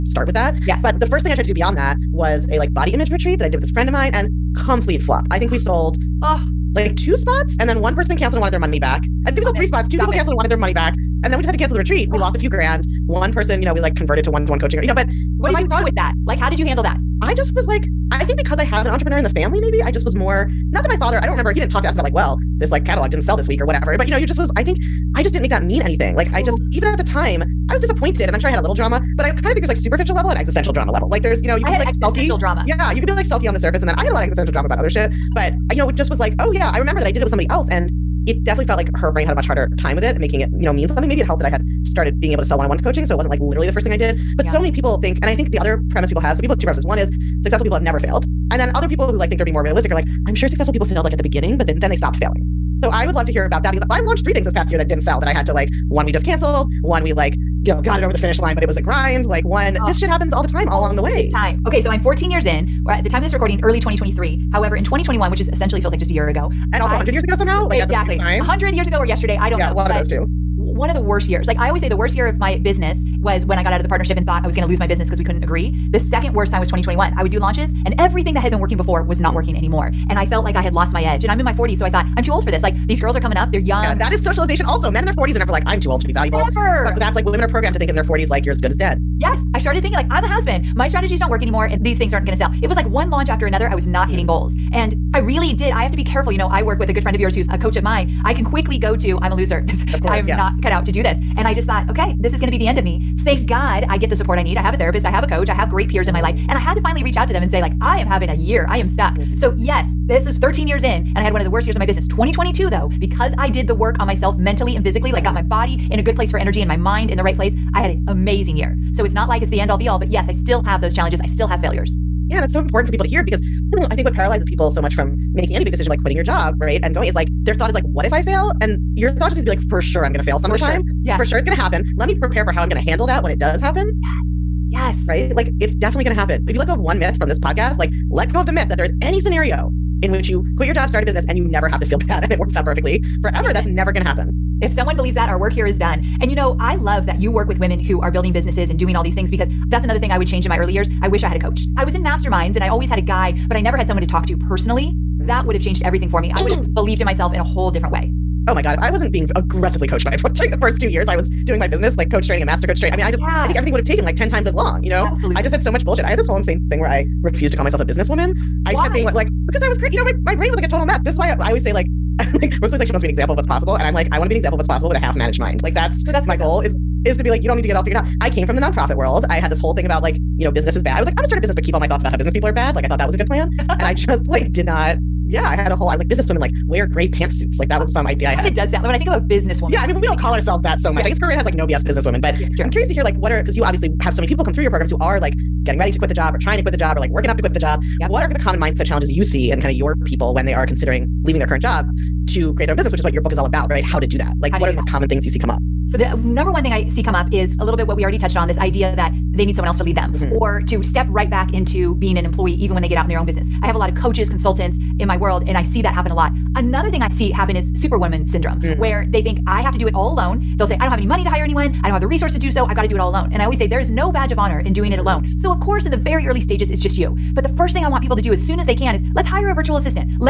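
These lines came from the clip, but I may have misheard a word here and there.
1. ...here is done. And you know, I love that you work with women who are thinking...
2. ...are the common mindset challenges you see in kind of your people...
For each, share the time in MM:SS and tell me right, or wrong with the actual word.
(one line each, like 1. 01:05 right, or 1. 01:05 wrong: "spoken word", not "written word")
1. 02:25 wrong: "building", not "thinking"
2. 03:18 right.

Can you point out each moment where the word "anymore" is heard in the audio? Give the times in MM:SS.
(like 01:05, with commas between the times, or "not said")
01:19, 01:31.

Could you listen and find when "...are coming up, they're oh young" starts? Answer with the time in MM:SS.
01:23.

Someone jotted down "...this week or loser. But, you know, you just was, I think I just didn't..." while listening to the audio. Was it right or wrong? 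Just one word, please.
wrong.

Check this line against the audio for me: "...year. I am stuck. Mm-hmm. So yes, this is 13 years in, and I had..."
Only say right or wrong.
right.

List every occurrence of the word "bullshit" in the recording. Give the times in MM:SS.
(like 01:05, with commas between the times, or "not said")
02:45.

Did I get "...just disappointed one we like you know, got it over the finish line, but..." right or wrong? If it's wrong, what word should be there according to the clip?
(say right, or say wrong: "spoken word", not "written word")
wrong: "canceled", not "disappointed".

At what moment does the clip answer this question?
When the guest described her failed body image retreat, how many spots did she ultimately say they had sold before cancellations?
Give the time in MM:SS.
00:09.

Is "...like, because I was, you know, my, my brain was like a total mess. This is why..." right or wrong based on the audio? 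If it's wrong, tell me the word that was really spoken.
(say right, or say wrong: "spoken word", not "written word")
right.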